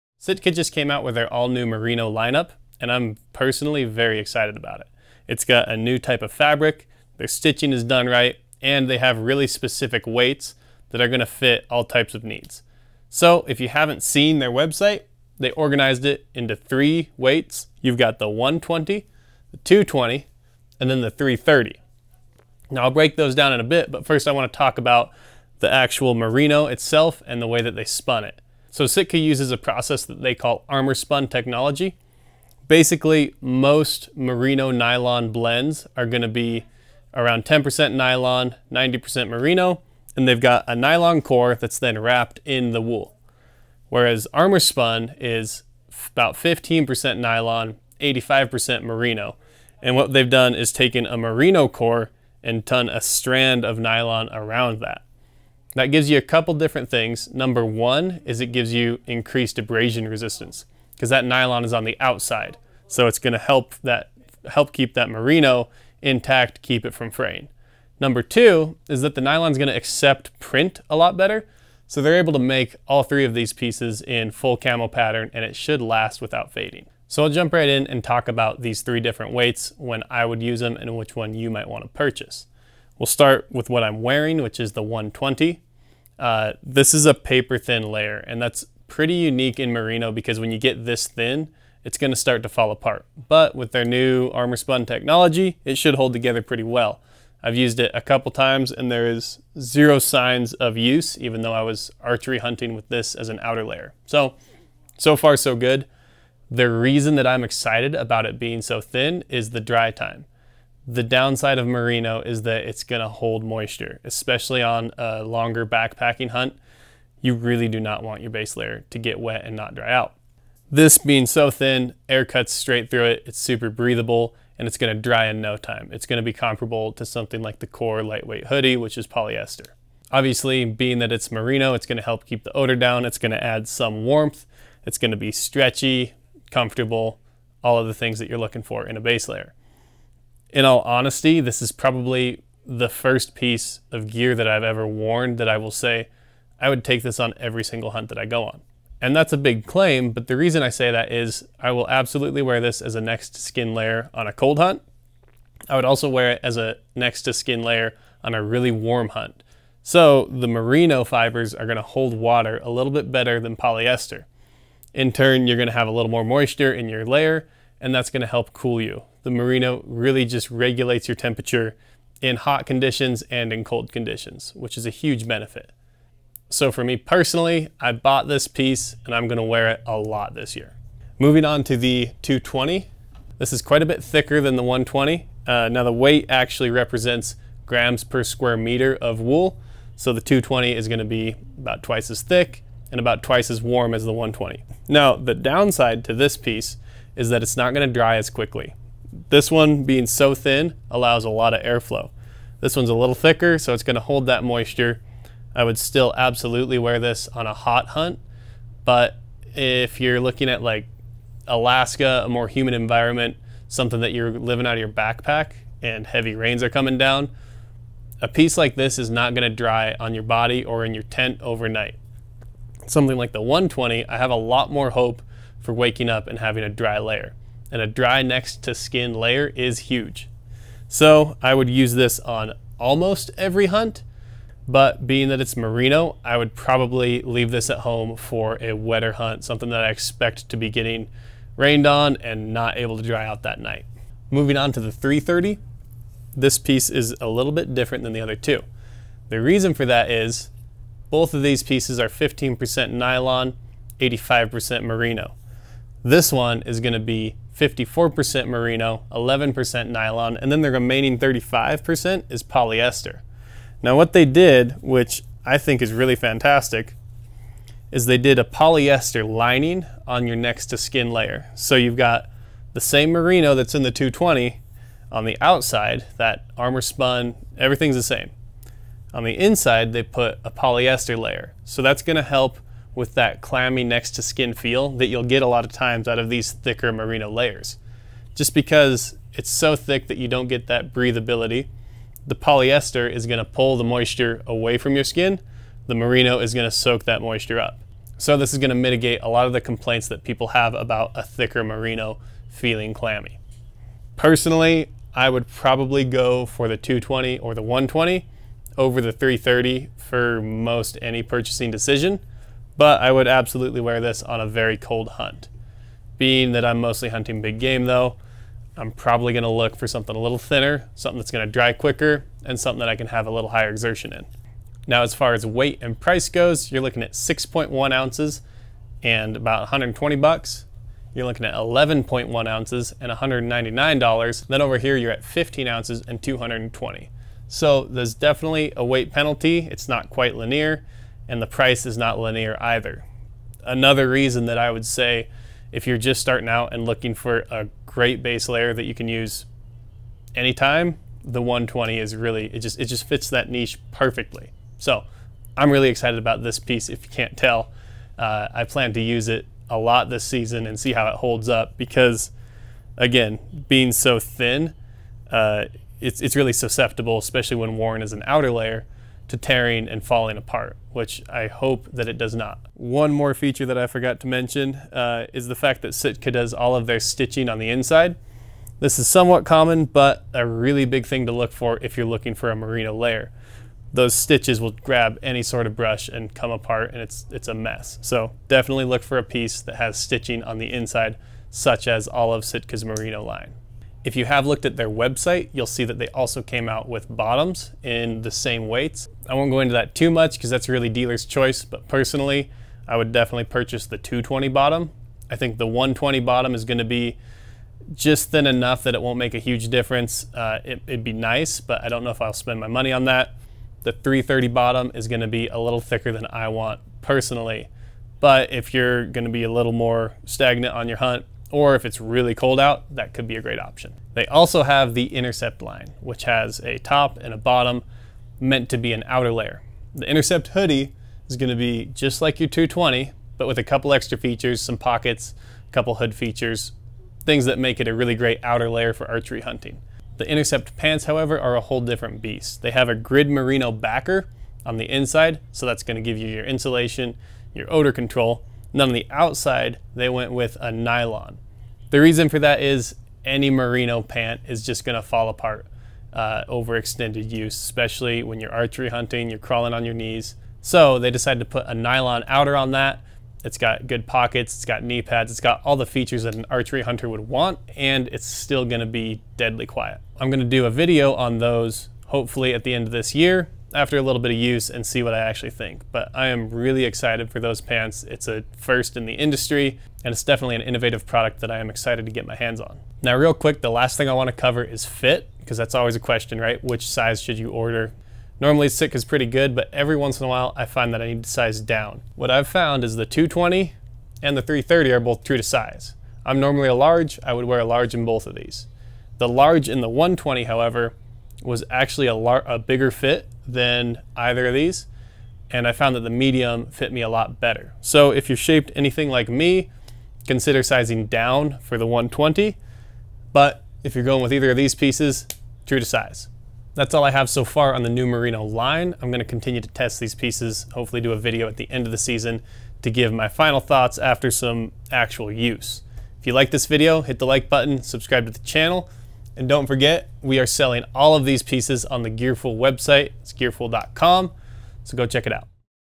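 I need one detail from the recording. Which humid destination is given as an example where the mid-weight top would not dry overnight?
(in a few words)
Alaska.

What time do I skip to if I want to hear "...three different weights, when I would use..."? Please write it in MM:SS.
01:18.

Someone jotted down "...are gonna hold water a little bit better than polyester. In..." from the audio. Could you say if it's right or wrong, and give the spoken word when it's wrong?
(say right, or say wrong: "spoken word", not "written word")
right.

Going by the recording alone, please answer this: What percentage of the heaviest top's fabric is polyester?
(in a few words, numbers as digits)
35%.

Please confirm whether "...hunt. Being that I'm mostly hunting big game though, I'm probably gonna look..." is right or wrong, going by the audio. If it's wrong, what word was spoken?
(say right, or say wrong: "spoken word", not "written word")
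right.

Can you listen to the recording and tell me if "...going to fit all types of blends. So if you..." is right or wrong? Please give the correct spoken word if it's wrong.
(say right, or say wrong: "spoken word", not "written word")
wrong: "needs", not "blends".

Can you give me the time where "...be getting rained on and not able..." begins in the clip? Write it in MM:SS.
04:00.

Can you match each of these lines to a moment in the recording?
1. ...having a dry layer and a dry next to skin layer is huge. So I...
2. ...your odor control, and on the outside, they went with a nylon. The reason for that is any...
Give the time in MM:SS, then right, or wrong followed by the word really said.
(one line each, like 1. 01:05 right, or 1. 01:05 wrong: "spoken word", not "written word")
1. 03:46 right
2. 07:27 right.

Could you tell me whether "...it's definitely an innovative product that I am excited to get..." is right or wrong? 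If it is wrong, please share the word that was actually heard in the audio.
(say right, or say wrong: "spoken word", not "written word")
right.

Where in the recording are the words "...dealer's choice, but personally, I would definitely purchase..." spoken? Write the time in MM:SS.
06:40.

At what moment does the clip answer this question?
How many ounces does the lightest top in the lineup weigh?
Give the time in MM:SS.
05:27.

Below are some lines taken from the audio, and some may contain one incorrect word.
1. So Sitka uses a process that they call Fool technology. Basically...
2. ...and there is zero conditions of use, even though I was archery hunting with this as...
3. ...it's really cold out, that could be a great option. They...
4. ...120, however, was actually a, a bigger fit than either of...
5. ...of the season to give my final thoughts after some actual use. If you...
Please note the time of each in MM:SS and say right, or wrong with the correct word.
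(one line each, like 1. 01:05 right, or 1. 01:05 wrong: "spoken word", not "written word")
1. 00:28 wrong: "ArmorSpun", not "Fool"
2. 01:38 wrong: "signs", not "conditions"
3. 07:01 right
4. 08:19 right
5. 08:41 right.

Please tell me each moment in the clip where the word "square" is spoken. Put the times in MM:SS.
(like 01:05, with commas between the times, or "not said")
03:08.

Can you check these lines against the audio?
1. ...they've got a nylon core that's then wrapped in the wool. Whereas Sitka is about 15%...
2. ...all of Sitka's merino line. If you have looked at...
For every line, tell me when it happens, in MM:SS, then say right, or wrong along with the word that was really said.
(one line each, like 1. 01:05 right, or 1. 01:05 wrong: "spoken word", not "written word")
1. 00:40 wrong: "ArmorSpun", not "Sitka"
2. 06:32 right.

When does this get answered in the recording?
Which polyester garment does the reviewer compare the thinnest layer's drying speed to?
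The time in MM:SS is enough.
02:07.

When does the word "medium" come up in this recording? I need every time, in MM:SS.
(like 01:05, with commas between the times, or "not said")
08:26.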